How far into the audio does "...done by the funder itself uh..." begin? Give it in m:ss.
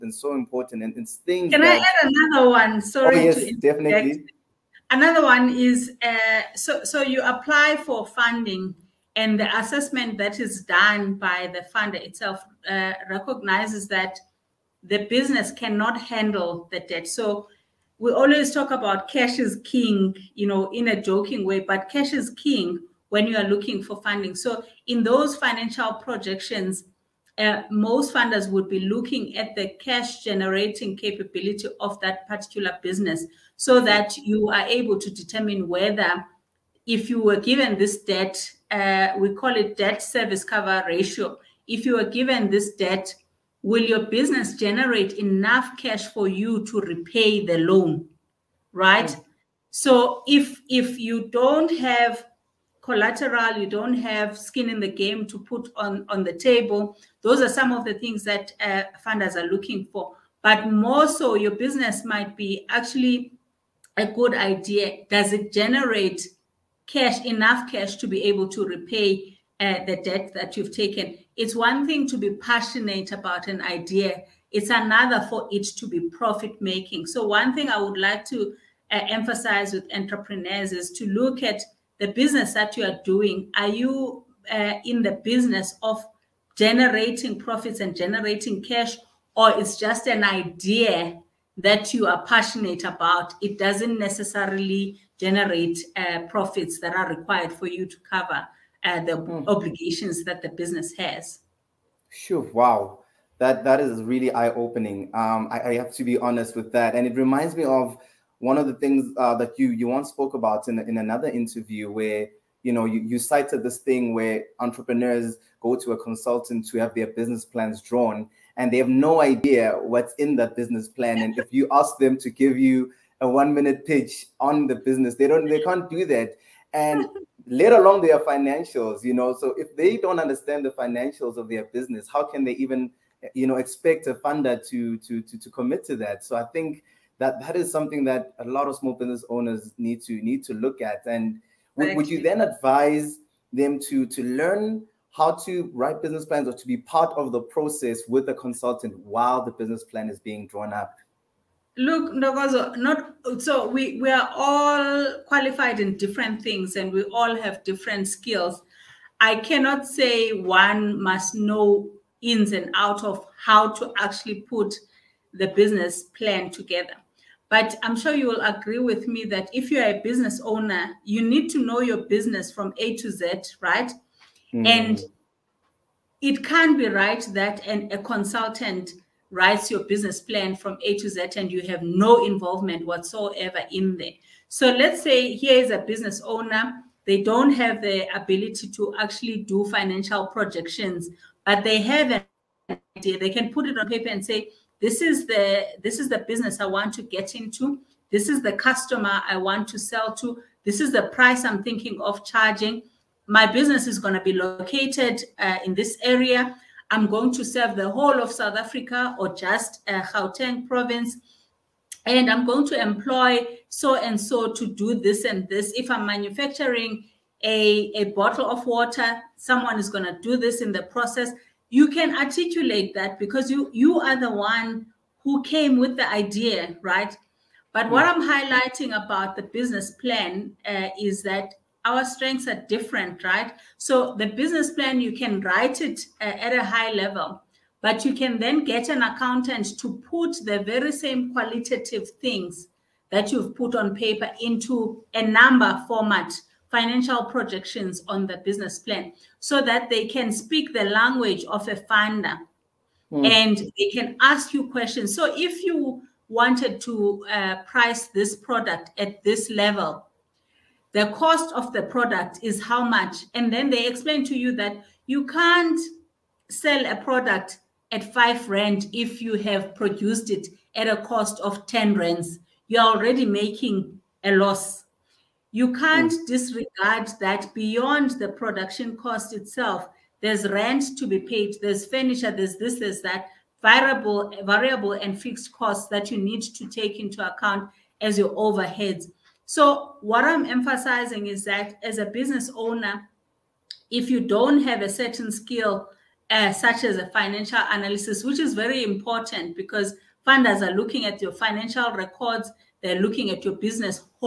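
0:10.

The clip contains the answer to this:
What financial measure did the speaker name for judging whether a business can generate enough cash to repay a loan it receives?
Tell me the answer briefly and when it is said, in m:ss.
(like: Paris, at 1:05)
debt service cover ratio, at 0:39.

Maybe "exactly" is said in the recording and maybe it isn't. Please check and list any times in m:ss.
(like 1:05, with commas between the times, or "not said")
not said.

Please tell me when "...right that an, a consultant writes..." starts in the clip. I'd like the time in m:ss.
2:56.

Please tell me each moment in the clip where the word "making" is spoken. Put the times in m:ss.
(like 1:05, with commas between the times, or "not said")
1:16, 4:33.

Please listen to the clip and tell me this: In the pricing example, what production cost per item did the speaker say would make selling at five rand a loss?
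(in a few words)
10 rand.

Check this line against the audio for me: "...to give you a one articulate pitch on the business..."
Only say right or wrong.
wrong.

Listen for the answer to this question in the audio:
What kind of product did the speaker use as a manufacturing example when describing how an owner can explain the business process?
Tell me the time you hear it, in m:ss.
3:38.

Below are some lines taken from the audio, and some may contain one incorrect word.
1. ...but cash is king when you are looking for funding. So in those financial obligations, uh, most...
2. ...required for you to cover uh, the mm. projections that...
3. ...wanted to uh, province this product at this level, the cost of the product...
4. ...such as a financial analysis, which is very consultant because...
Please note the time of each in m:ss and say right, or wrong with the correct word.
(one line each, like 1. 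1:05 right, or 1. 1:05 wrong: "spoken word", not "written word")
1. 0:21 wrong: "projections", not "obligations"
2. 1:37 wrong: "obligations", not "projections"
3. 4:16 wrong: "price", not "province"
4. 4:56 wrong: "important", not "consultant".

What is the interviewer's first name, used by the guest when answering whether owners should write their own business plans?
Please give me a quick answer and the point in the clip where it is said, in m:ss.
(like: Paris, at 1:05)
Ntokozo, at 2:32.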